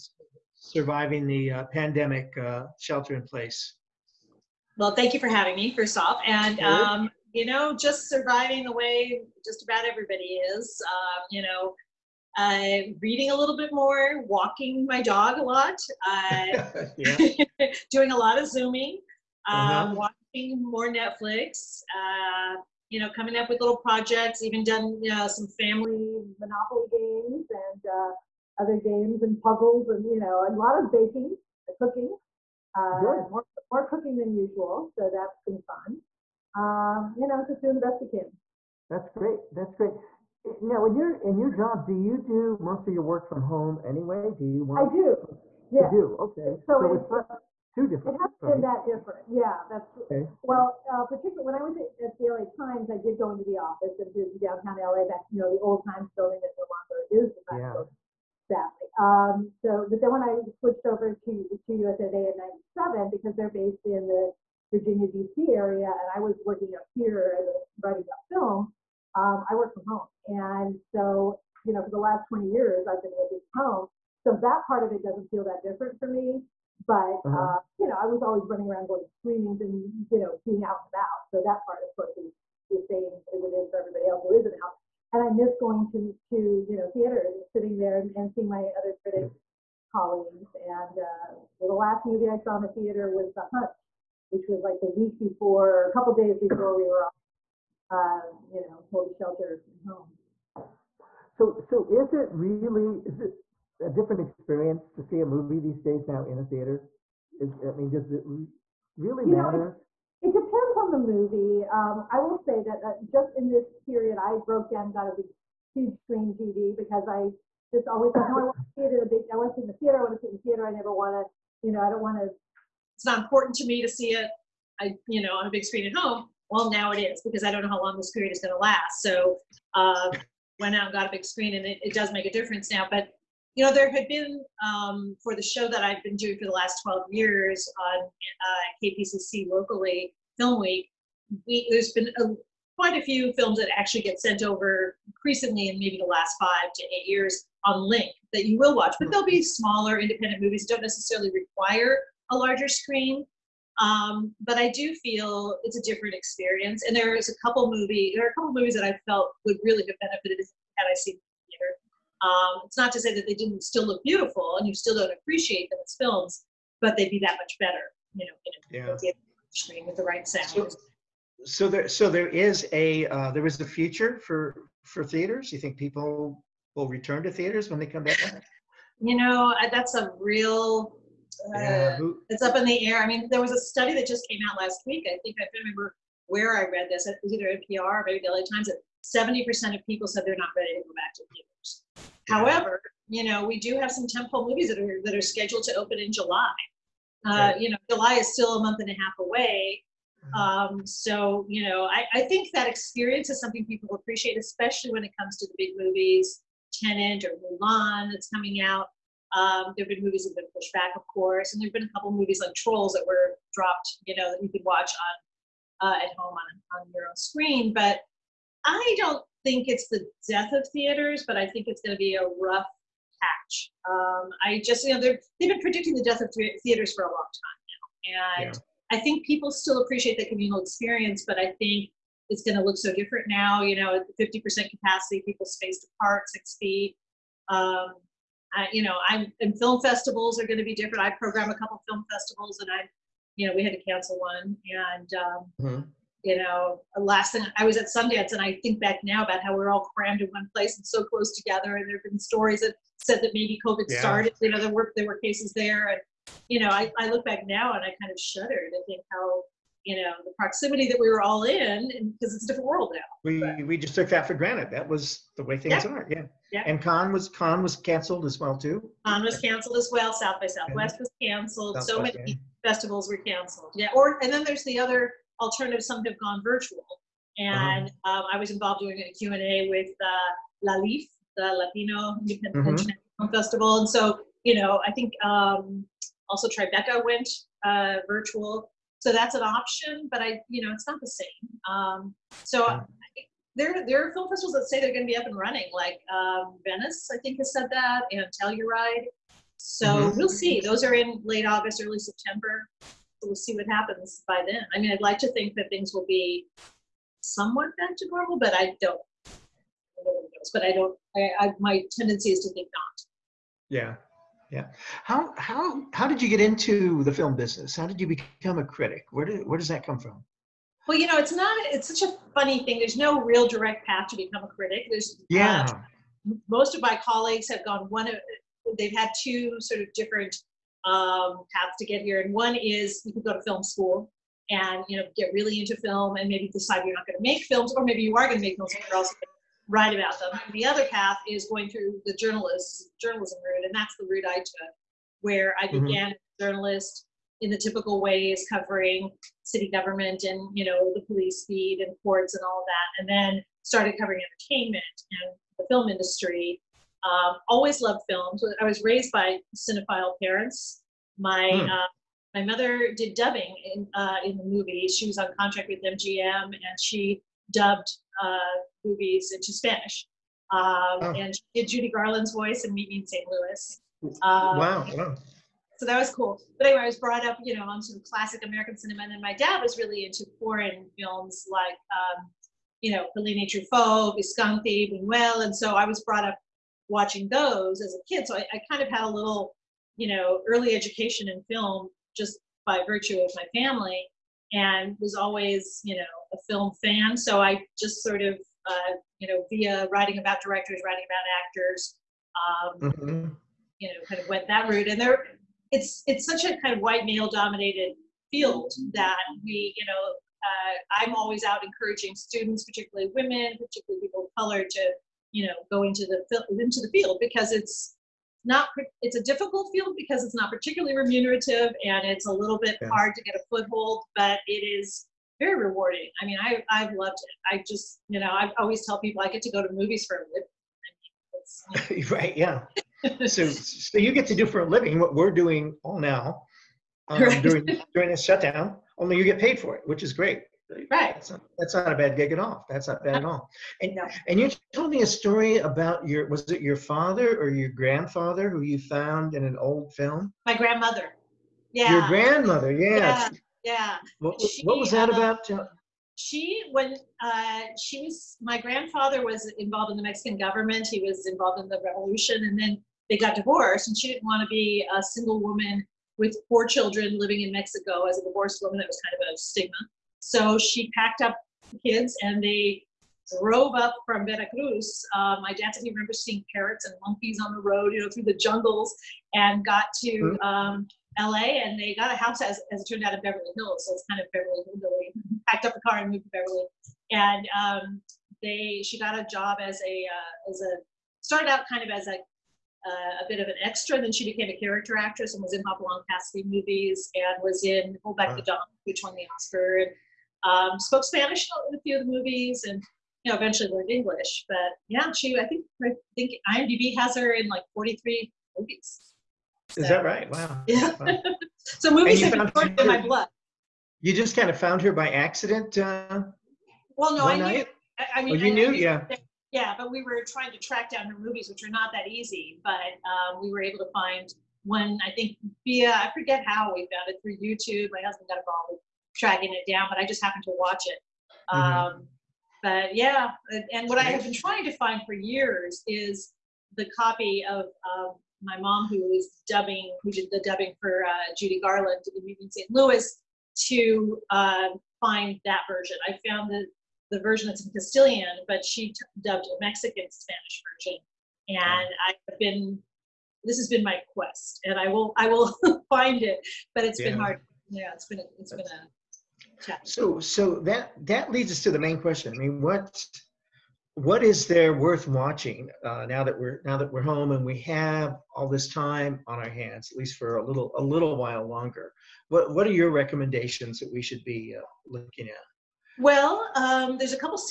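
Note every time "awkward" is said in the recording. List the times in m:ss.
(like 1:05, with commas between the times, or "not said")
not said.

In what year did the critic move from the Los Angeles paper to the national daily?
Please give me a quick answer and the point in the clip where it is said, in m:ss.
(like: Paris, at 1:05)
1997, at 1:02.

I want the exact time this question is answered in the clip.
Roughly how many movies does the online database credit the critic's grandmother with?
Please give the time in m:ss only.
8:27.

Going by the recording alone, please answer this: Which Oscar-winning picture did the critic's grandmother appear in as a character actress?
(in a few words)
Hold Back the Dawn.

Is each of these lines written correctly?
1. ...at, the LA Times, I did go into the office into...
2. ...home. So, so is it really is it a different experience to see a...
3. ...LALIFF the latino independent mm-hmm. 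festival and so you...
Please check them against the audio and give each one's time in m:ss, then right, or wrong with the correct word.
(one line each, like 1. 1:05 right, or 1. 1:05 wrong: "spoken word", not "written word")
1. 0:52 right
2. 1:39 right
3. 4:40 right.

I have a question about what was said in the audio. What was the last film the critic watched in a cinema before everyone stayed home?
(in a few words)
The Hunt.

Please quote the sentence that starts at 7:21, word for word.
That's not, that's not, a bad gig at all.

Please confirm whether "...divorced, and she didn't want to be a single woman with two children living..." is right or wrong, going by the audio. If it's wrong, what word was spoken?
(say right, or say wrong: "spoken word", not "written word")
wrong: "four", not "two".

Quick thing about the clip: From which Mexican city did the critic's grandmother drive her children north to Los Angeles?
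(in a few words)
Veracruz.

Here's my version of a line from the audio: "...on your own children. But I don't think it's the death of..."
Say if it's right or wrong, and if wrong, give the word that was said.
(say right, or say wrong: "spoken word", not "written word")
wrong: "screen", not "children".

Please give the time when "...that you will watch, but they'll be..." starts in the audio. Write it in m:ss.
2:28.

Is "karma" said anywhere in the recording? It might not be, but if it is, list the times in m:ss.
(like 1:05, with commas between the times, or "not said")
not said.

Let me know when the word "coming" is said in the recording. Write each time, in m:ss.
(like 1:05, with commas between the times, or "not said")
0:23, 3:28.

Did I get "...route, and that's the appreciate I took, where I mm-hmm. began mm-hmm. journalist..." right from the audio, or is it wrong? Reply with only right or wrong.
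wrong.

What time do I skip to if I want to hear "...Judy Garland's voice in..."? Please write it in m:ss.
6:11.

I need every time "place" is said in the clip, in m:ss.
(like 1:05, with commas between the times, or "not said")
0:03, 4:10.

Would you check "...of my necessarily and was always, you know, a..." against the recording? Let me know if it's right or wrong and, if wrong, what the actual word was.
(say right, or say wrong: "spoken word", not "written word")
wrong: "family", not "necessarily".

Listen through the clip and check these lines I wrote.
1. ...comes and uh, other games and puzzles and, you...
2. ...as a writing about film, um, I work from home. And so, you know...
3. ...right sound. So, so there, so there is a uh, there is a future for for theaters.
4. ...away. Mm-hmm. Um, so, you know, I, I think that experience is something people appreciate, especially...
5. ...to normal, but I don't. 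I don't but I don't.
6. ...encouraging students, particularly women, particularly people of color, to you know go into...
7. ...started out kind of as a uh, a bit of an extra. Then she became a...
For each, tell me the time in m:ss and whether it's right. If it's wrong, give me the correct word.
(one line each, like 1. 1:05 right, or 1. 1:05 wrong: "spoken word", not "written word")
1. 0:26 wrong: "games", not "comes"
2. 1:07 right
3. 2:50 right
4. 3:19 right
5. 5:07 right
6. 6:51 right
7. 8:11 right.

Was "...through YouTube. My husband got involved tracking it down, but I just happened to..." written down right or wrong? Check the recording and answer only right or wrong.
right.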